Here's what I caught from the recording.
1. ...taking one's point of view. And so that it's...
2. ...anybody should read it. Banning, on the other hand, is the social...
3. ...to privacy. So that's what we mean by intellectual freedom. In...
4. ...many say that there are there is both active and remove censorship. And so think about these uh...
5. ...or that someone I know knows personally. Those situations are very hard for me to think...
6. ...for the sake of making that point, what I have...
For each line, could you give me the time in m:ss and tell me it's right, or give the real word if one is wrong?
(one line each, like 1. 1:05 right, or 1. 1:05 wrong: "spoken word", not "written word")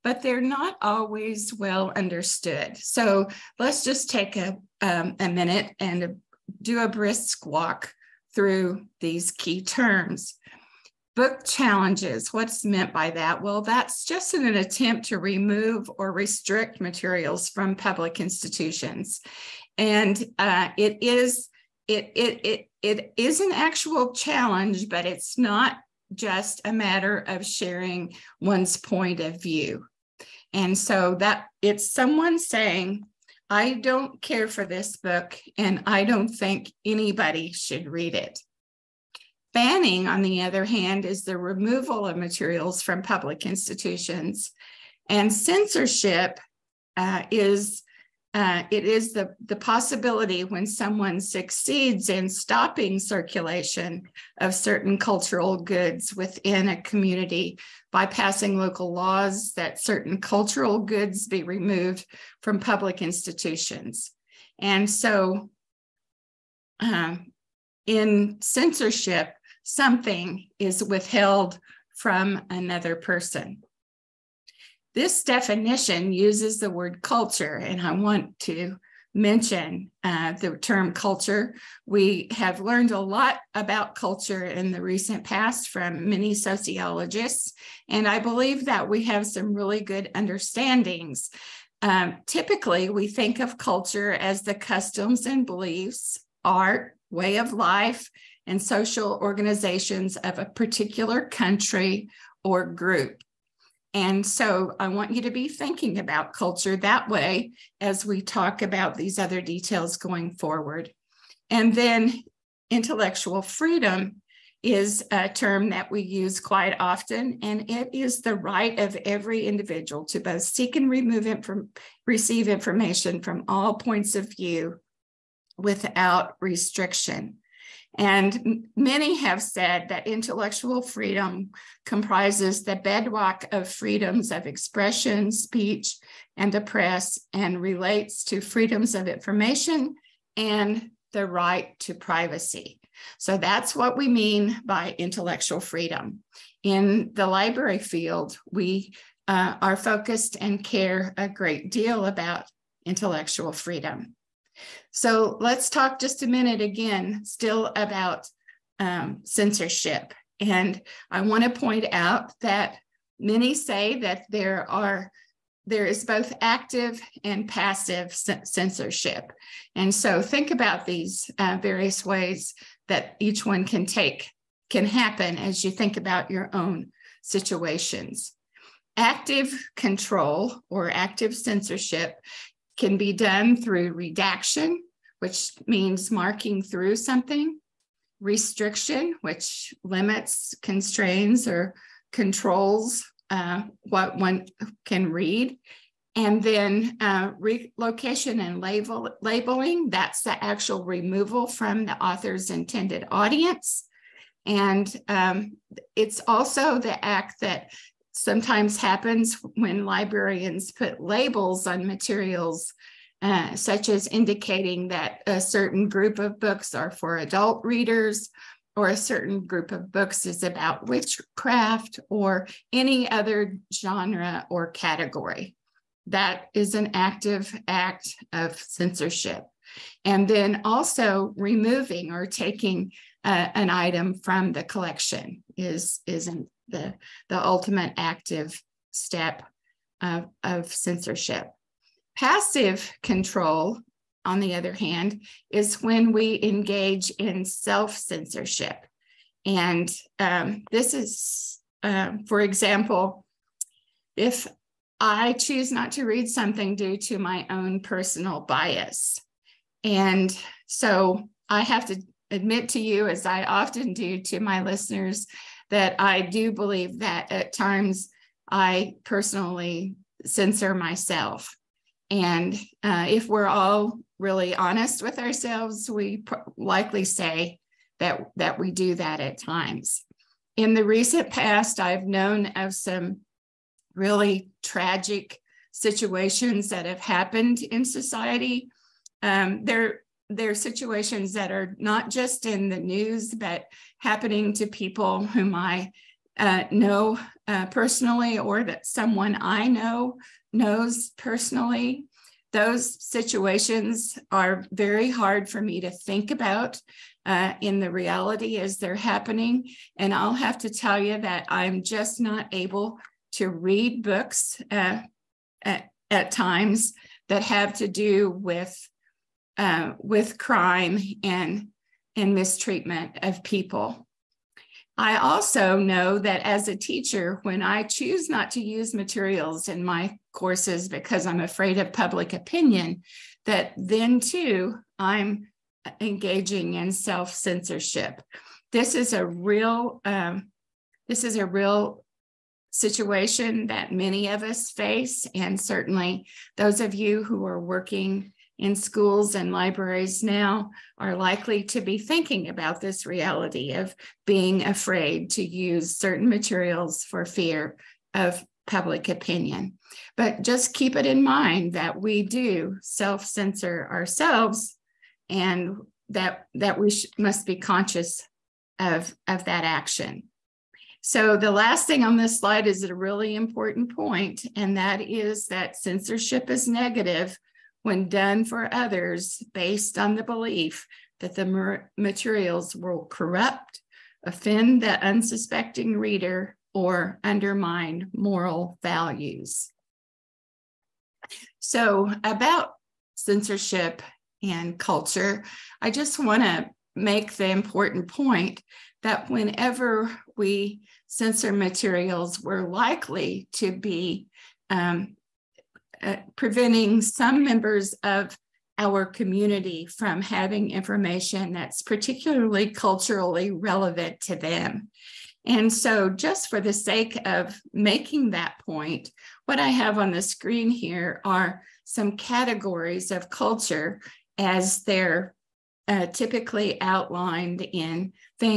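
1. 0:27 wrong: "sharing", not "taking"
2. 0:36 wrong: "removal", not "social"
3. 2:21 right
4. 2:43 wrong: "passive", not "remove"
5. 4:58 right
6. 6:56 right.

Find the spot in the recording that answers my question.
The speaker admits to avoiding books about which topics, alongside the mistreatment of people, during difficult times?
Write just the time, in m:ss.
5:20.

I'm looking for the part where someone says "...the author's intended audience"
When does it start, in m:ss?
3:21.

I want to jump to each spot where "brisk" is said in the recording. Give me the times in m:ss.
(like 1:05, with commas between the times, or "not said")
0:06.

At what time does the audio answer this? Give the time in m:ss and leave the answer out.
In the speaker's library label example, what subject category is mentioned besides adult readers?
3:40.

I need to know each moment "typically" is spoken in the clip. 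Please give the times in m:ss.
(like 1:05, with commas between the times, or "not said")
1:32, 7:06.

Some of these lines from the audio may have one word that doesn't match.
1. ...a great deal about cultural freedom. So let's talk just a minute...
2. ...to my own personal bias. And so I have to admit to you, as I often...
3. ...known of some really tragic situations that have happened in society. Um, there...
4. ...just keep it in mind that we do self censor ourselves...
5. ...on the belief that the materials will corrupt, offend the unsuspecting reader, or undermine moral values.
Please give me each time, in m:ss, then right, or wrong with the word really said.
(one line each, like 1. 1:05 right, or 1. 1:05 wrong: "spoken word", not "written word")
1. 2:31 wrong: "intellectual", not "cultural"
2. 4:16 right
3. 4:42 right
4. 6:00 right
5. 6:19 right.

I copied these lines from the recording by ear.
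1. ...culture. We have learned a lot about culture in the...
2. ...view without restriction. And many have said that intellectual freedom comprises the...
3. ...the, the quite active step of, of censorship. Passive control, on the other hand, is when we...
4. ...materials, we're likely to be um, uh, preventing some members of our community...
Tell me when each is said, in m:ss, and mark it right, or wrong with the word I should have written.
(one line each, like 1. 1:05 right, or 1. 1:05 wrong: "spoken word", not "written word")
1. 1:20 right
2. 2:04 right
3. 3:56 wrong: "ultimate", not "quite"
4. 6:41 right.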